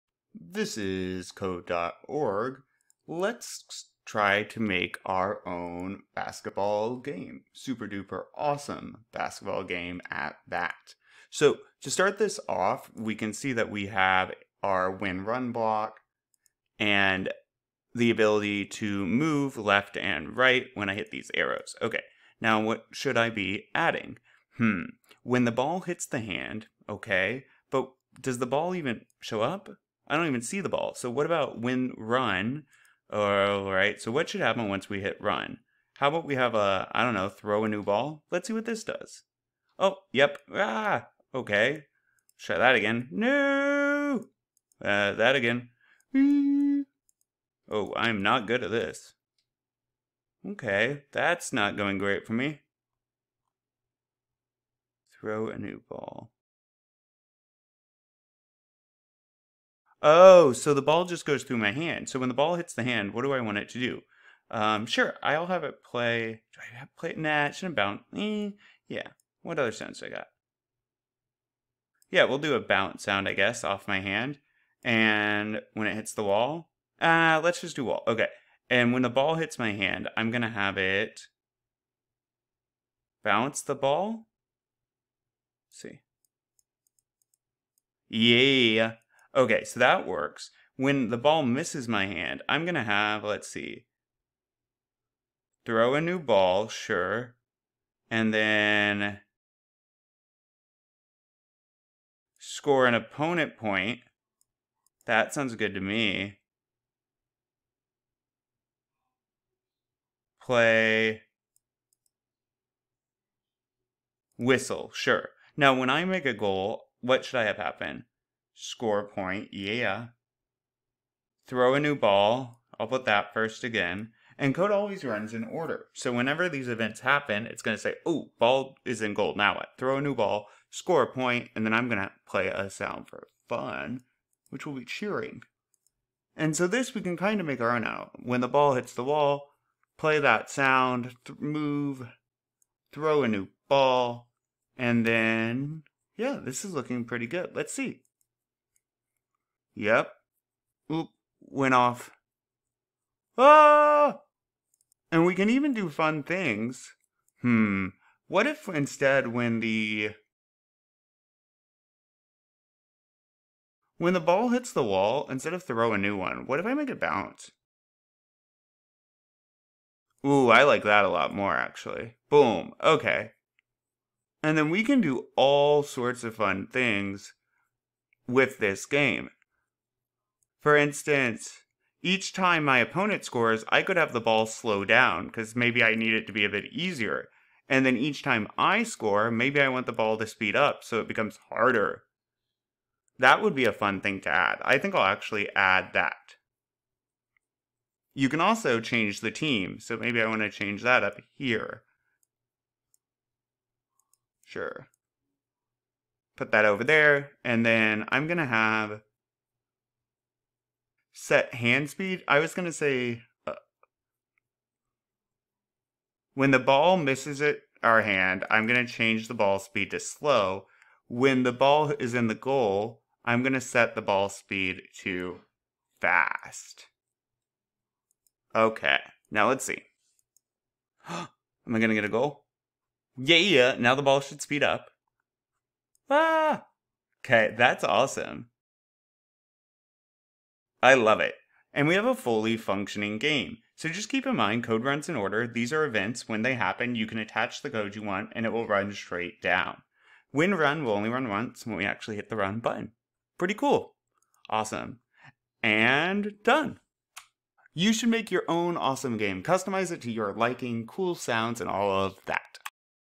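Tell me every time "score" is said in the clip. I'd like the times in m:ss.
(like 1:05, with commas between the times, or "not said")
1:42, 1:58, 2:10, 3:03, 3:08.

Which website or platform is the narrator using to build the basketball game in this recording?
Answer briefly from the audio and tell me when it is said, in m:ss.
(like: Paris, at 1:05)
code.org, at 0:01.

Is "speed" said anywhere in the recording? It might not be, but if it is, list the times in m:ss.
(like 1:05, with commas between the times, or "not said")
3:10, 3:31, 3:39, 3:44, 3:54.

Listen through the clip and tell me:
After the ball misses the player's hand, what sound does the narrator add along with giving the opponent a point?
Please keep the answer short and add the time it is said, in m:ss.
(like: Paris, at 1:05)
whistle, at 1:50.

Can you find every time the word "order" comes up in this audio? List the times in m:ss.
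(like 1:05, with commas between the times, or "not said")
2:05, 4:05.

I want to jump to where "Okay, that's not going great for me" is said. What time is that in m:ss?
0:50.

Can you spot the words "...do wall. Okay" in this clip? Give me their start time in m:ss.
1:17.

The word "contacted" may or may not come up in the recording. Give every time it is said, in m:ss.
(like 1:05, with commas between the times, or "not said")
not said.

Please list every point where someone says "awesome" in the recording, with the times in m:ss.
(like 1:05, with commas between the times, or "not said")
0:08, 3:57, 4:14, 4:18.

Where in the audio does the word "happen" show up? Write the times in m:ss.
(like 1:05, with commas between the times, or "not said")
0:34, 1:57, 2:07, 4:06.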